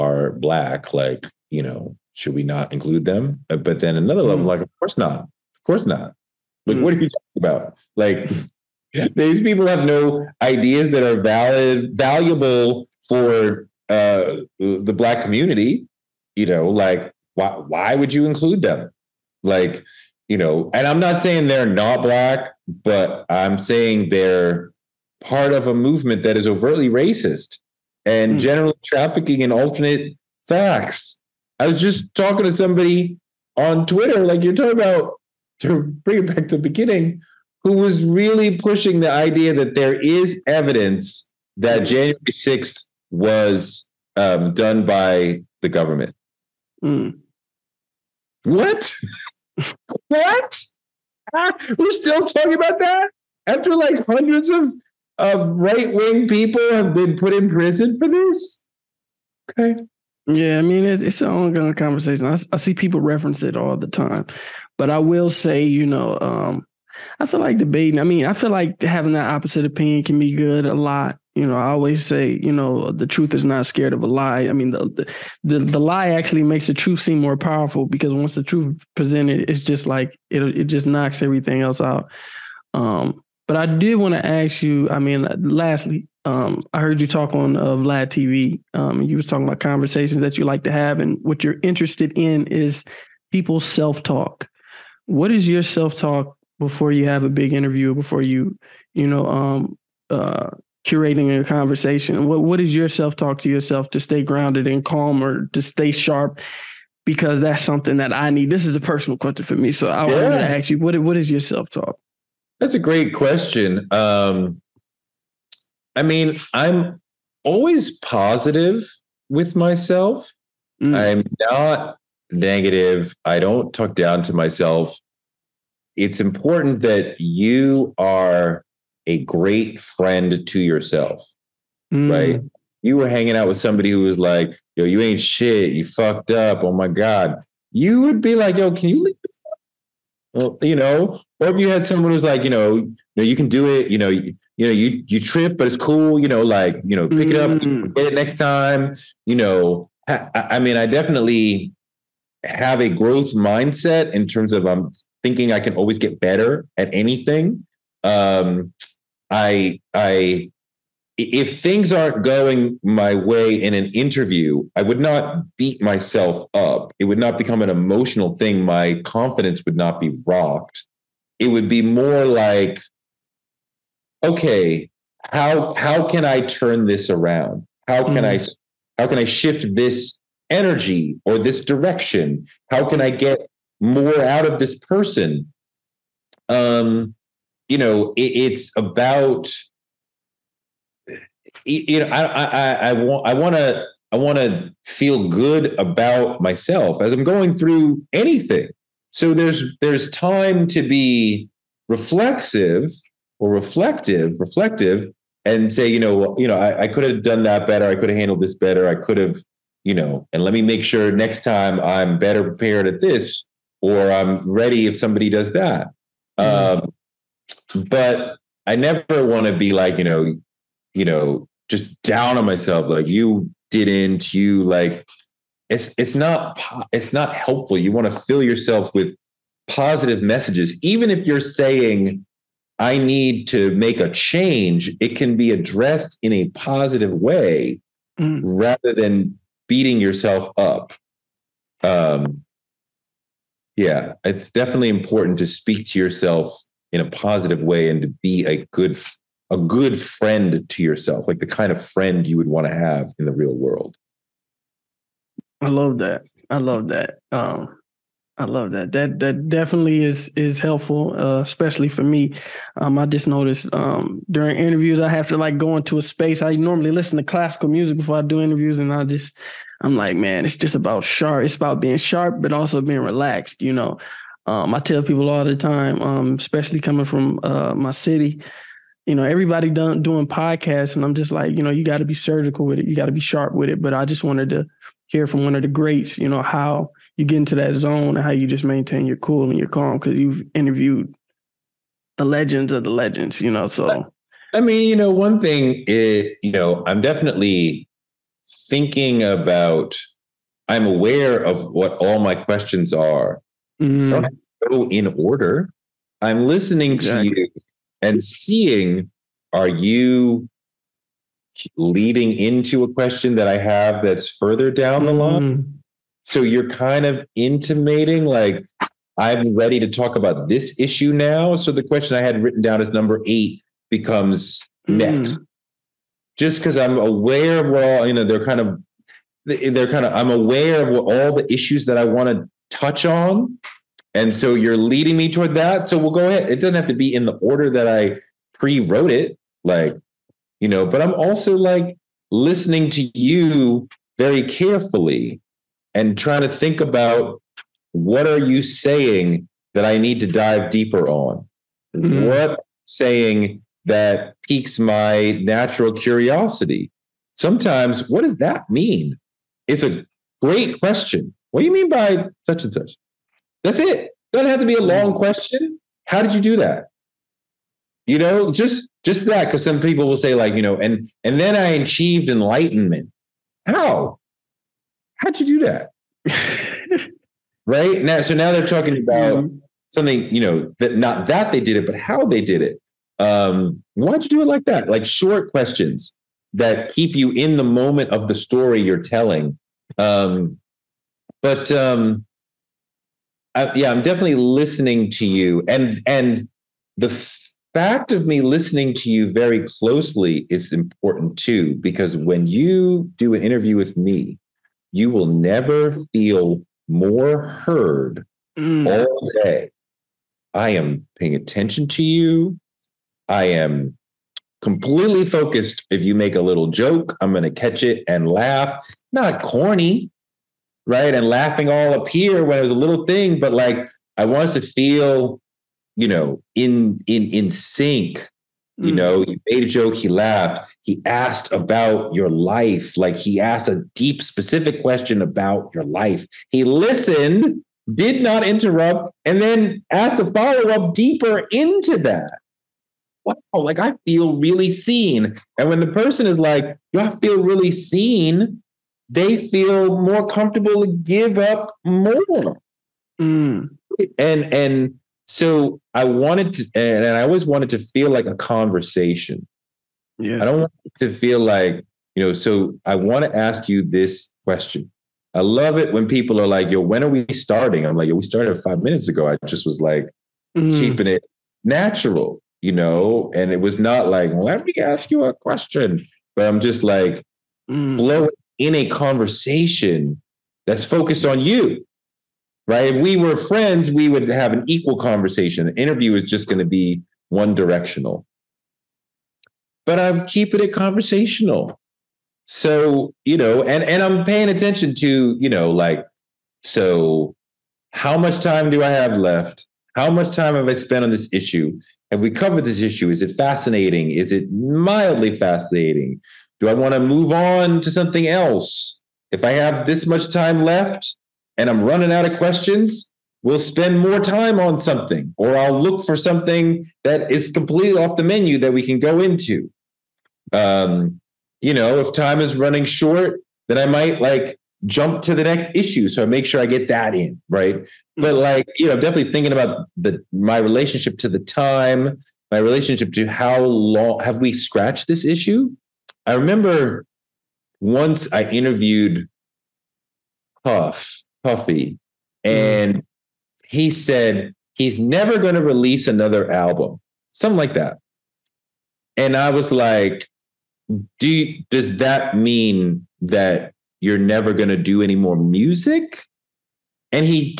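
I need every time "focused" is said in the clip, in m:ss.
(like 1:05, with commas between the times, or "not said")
6:55, 8:00.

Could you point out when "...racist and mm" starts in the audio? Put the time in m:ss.
0:26.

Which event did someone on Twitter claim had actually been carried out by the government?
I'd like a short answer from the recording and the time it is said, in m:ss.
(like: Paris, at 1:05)
January 6th, at 0:41.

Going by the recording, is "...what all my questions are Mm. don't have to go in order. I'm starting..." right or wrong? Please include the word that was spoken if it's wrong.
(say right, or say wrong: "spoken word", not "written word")
wrong: "listening", not "starting".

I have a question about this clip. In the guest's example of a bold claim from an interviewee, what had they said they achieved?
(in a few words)
enlightenment.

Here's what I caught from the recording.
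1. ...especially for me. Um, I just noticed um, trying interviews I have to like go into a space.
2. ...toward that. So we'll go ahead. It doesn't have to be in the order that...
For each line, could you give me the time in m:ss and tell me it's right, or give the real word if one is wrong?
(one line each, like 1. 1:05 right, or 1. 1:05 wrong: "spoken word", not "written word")
1. 4:21 wrong: "during", not "trying"
2. 5:35 right.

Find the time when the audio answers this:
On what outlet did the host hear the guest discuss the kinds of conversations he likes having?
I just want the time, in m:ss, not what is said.
1:27.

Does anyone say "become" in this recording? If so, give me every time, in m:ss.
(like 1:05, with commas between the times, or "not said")
2:47, 5:23.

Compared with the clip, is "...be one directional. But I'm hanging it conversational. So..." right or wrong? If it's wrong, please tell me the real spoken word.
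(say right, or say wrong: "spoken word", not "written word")
wrong: "keeping", not "hanging".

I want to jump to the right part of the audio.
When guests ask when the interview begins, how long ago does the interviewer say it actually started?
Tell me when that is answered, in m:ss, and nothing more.
7:48.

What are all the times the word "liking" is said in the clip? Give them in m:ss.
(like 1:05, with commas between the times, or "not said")
not said.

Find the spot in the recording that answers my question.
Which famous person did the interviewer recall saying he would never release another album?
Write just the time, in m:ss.
9:00.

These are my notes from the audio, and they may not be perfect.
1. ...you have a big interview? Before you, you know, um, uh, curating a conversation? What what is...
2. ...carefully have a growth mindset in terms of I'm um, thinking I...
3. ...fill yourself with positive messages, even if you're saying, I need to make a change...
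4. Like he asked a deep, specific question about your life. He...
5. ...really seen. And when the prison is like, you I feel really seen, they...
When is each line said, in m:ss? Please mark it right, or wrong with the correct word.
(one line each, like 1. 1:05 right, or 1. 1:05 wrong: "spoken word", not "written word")
1. 1:36 right
2. 2:30 wrong: "definitely", not "carefully"
3. 3:48 right
4. 7:12 right
5. 7:24 wrong: "person", not "prison".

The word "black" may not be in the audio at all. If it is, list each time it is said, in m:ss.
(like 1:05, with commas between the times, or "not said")
0:00, 0:14, 0:22.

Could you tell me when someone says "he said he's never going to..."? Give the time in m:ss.
9:03.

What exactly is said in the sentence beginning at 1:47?
Because that's something that I need.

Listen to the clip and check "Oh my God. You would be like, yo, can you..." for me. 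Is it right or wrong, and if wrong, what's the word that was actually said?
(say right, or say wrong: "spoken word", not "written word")
right.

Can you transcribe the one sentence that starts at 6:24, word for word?
Like short questions that keep you in the moment of the story you're telling.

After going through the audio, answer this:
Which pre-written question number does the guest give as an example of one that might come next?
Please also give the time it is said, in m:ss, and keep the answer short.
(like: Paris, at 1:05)
8, at 5:22.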